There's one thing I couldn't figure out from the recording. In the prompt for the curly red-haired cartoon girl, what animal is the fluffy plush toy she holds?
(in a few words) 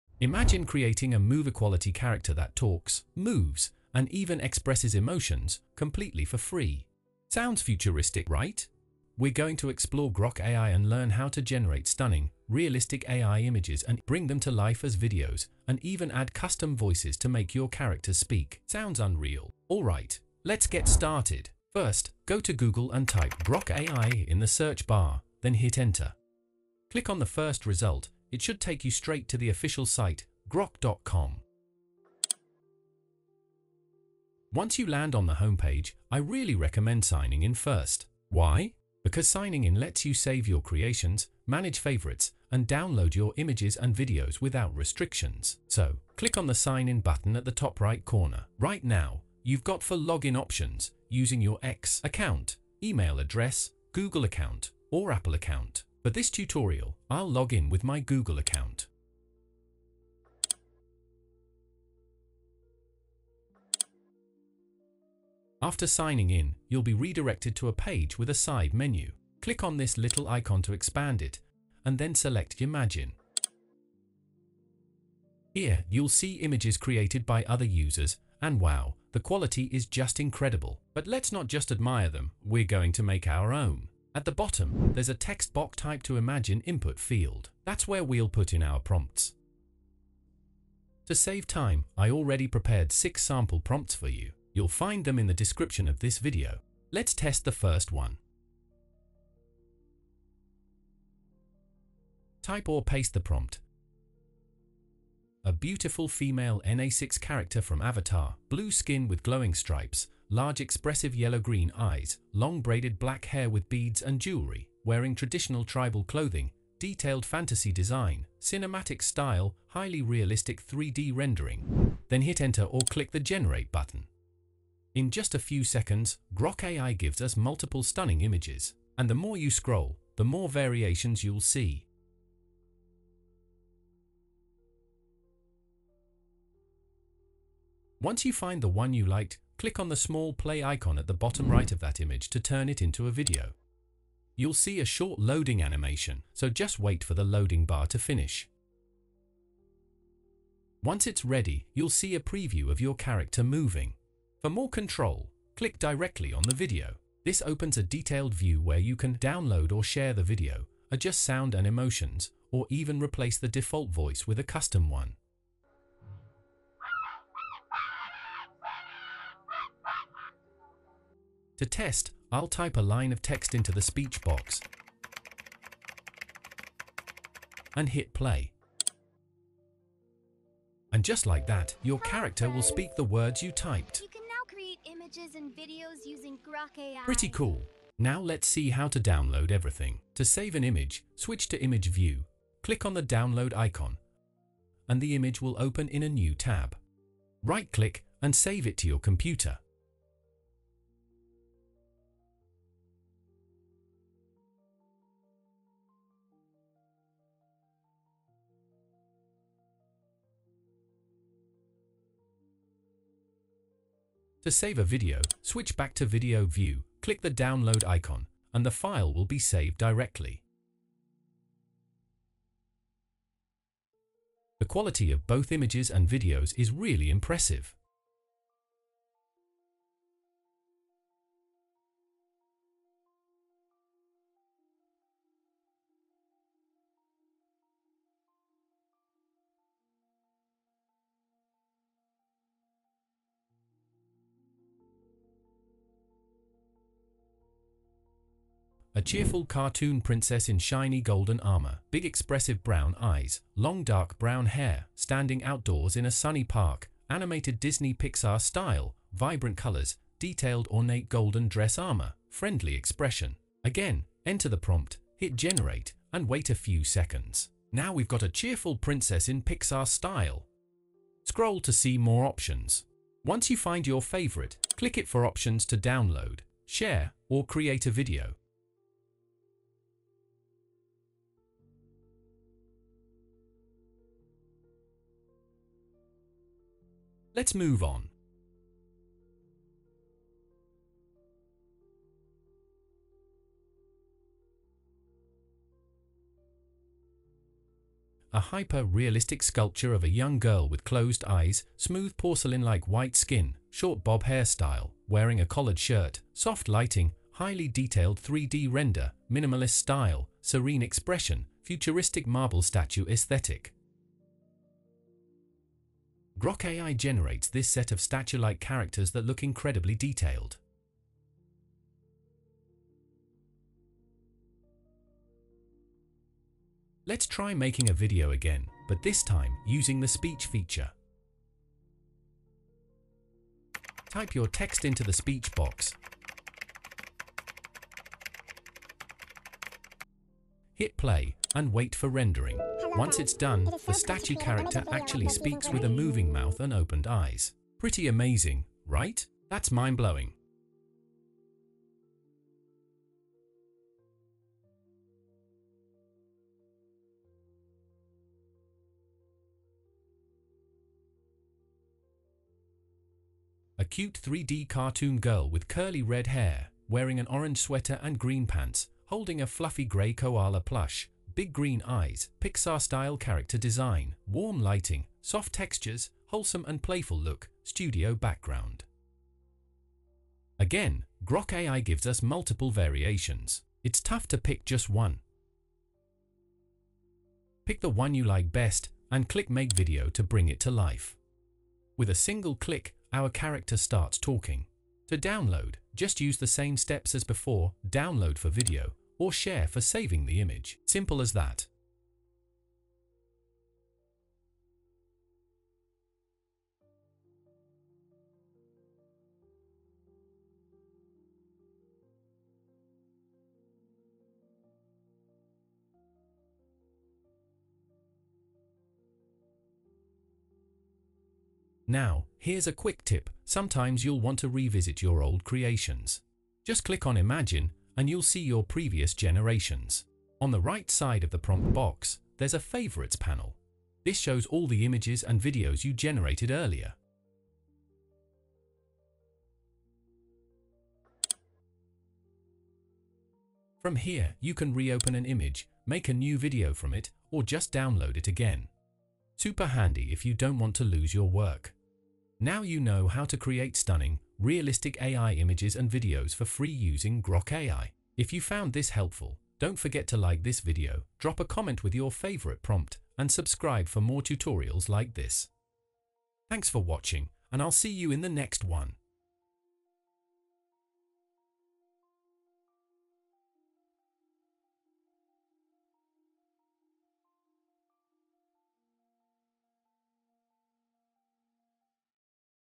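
Koala.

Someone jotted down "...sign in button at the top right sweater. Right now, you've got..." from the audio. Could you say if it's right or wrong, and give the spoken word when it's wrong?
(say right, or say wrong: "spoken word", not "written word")
wrong: "corner", not "sweater".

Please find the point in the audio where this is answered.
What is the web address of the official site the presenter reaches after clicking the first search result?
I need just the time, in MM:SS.
00:30.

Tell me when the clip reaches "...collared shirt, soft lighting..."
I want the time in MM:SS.
05:05.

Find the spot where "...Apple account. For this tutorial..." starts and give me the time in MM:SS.
00:55.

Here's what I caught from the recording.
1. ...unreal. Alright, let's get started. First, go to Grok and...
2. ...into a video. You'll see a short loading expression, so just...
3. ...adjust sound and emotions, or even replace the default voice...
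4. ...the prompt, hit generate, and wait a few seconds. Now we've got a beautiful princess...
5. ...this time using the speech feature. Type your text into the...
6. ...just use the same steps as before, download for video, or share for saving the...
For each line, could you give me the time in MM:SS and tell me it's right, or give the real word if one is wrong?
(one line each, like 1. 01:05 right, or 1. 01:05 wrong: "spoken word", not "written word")
1. 00:18 wrong: "Google", not "Grok"
2. 02:22 wrong: "animation", not "expression"
3. 02:40 right
4. 04:24 wrong: "cheerful", not "beautiful"
5. 05:29 right
6. 06:35 right.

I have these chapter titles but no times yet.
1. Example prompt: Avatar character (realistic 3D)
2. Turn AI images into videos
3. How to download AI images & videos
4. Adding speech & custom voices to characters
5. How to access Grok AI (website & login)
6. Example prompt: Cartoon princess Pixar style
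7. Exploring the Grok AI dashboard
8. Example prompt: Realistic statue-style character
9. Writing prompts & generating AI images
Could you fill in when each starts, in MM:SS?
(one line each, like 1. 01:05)
1. 01:42
2. 02:18
3. 03:07
4. 02:51
5. 00:22
6. 04:08
7. 01:05
8. 04:58
9. 01:15.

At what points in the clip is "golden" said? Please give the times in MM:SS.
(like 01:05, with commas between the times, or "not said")
04:10, 04:21.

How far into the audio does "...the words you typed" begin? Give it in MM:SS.
03:02.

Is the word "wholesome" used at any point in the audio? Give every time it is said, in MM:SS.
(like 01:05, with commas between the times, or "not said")
06:16.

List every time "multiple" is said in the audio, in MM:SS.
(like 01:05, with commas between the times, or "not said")
02:07, 06:22.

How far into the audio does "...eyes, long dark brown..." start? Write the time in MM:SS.
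04:12.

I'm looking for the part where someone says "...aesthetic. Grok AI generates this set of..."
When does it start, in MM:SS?
05:13.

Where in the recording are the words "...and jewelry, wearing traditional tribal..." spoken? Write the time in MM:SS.
01:54.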